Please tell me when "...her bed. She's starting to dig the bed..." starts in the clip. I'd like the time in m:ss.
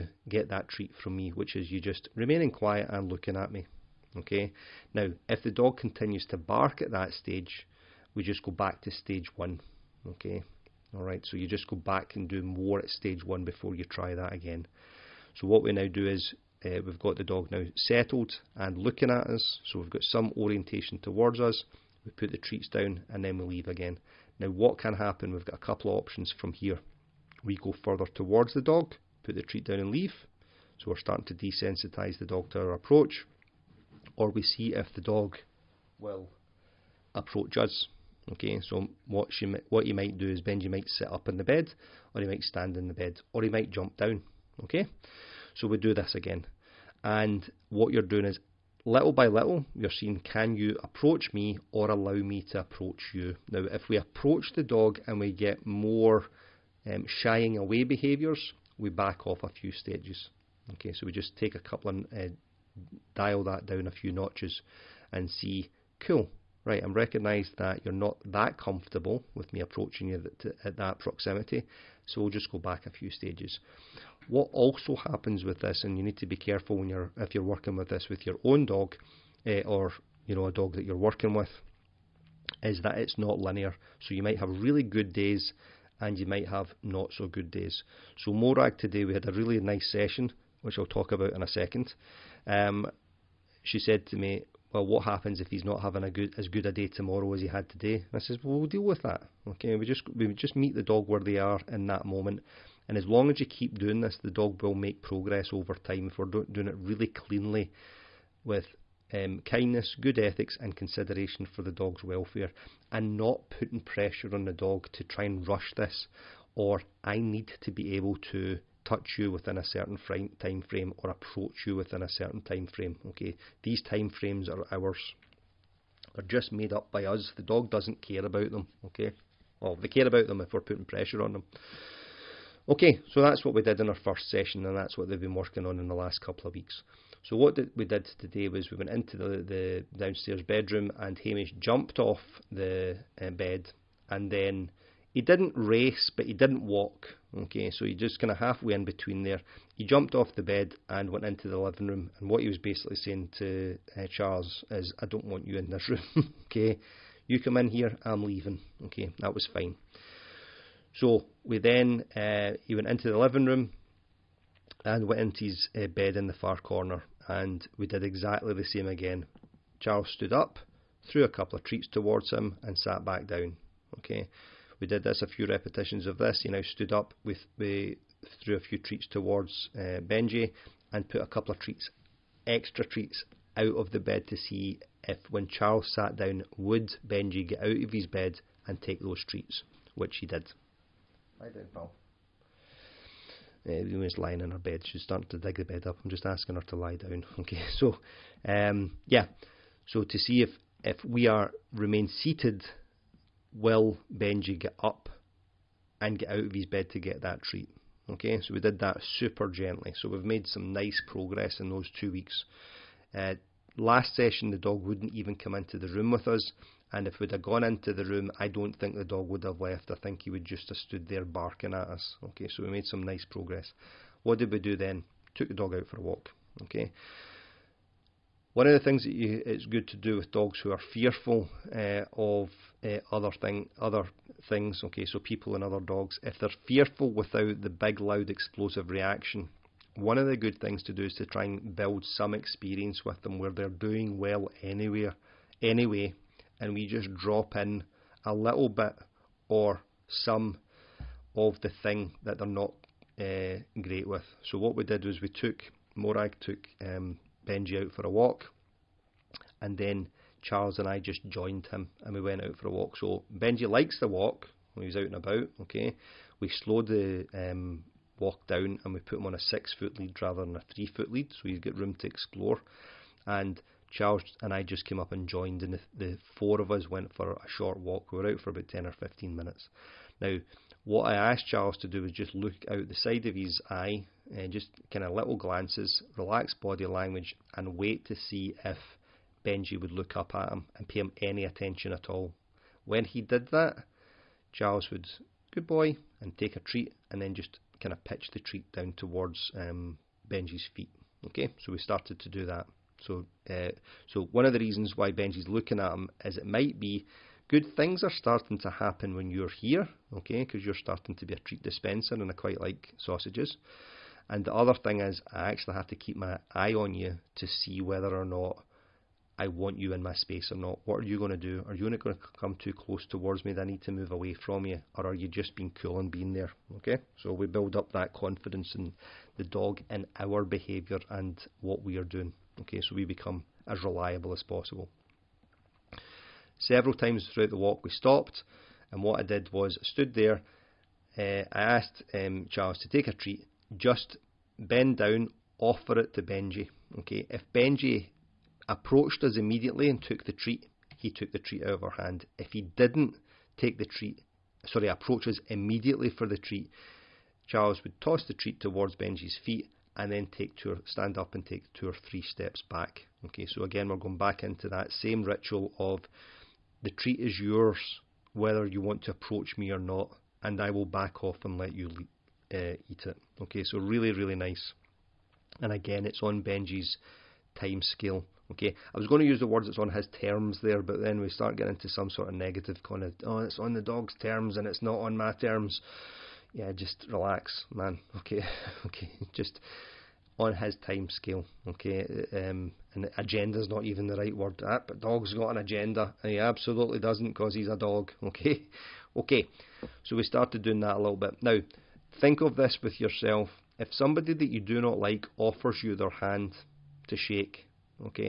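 3:14.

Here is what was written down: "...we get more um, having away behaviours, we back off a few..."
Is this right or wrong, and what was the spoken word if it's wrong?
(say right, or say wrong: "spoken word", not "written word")
wrong: "shying", not "having".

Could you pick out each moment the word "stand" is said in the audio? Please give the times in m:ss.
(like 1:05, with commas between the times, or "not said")
0:42, 6:00.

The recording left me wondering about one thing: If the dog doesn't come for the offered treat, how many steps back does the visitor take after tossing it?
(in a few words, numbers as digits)
2 or 3.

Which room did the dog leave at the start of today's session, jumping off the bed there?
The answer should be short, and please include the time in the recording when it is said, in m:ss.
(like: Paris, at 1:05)
downstairs bedroom, at 2:19.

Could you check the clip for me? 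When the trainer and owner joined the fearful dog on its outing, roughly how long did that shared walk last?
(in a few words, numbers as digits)
10 or 15 minutes.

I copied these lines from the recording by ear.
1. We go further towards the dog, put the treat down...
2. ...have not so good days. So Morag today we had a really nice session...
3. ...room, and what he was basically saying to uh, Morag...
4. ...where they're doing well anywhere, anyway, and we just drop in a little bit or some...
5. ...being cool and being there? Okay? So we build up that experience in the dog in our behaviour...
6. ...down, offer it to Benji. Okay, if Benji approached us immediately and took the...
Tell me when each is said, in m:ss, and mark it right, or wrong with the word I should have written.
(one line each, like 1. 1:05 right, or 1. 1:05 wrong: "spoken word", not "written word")
1. 0:27 right
2. 1:26 right
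3. 2:31 wrong: "Charles", not "Morag"
4. 4:03 right
5. 5:25 wrong: "confidence", not "experience"
6. 5:44 right.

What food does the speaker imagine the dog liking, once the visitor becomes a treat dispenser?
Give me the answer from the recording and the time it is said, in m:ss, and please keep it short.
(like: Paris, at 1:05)
sausages, at 5:12.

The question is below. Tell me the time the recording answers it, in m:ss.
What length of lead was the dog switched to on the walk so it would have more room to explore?
4:29.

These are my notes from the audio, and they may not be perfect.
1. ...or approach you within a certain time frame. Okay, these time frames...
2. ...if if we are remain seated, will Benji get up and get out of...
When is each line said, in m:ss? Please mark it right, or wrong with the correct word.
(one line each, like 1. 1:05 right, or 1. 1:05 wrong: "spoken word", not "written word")
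1. 2:00 right
2. 3:20 right.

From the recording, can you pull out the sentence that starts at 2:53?
Okay, we did this a few repetitions of this.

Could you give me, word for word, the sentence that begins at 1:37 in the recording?
And I says, well, we'll deal with that.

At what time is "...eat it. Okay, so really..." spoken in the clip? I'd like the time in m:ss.
6:12.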